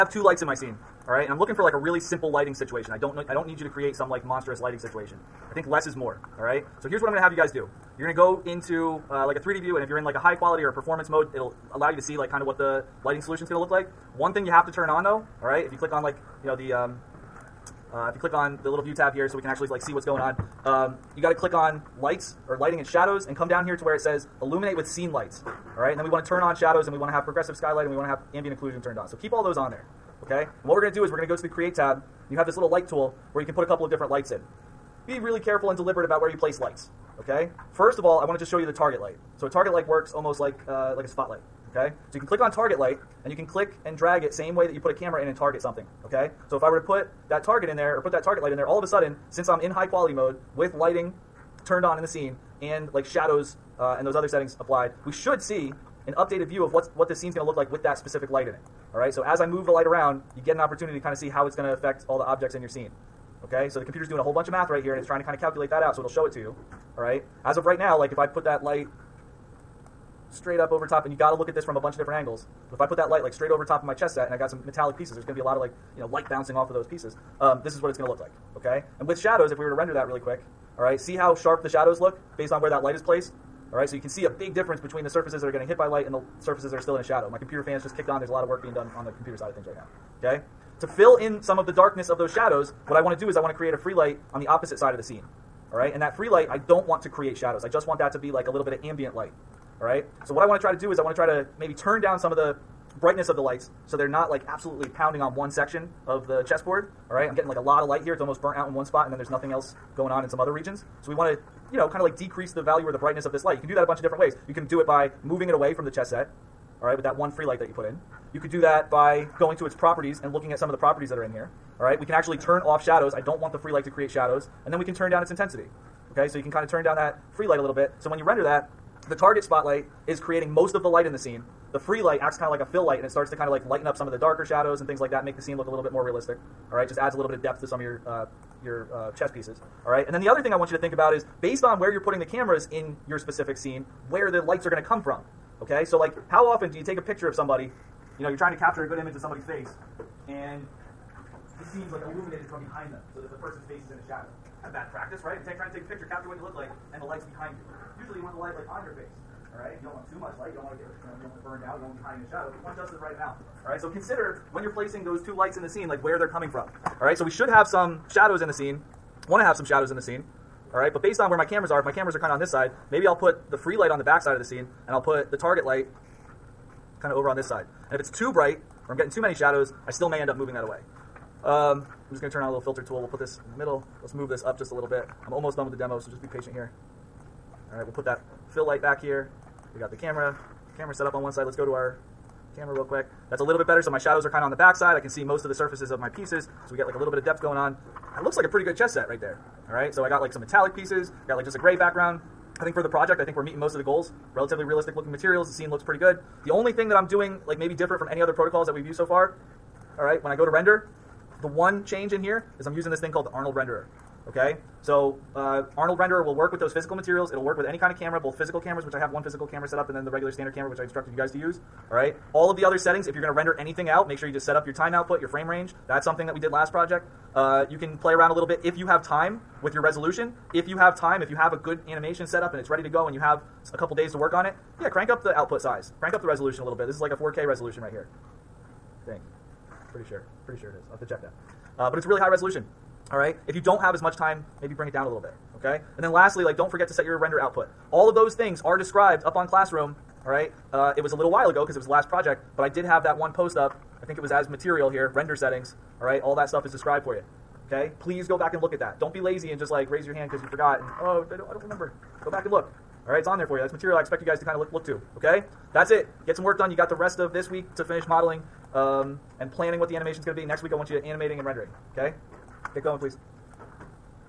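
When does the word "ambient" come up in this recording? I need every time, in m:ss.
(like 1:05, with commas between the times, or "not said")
0:28, 1:38.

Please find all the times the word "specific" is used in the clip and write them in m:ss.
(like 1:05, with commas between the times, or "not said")
0:57, 2:23.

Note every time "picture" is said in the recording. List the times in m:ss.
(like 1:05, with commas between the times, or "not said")
2:27, 2:35.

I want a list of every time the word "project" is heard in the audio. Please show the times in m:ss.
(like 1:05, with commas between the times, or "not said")
3:22, 3:46, 4:12.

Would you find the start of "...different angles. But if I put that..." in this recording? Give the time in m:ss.
1:11.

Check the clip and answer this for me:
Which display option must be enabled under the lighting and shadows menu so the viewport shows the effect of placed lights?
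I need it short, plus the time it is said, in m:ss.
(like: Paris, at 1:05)
Illuminate with scene lights, at 0:24.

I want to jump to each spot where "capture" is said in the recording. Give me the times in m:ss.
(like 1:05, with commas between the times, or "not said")
2:28, 2:36.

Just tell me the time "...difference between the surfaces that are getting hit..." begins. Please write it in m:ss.
1:24.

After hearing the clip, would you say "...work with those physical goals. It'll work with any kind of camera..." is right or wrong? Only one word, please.
wrong.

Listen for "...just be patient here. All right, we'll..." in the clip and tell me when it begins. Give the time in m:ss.
3:06.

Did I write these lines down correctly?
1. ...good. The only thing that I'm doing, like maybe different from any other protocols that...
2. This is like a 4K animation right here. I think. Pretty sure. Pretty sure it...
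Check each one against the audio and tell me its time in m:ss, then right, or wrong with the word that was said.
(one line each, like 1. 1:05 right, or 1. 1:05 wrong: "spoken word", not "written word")
1. 3:25 right
2. 3:56 wrong: "resolution", not "animation".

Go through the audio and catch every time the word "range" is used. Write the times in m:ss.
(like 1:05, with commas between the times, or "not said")
3:45.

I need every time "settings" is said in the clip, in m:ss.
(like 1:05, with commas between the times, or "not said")
0:54, 3:42, 4:15.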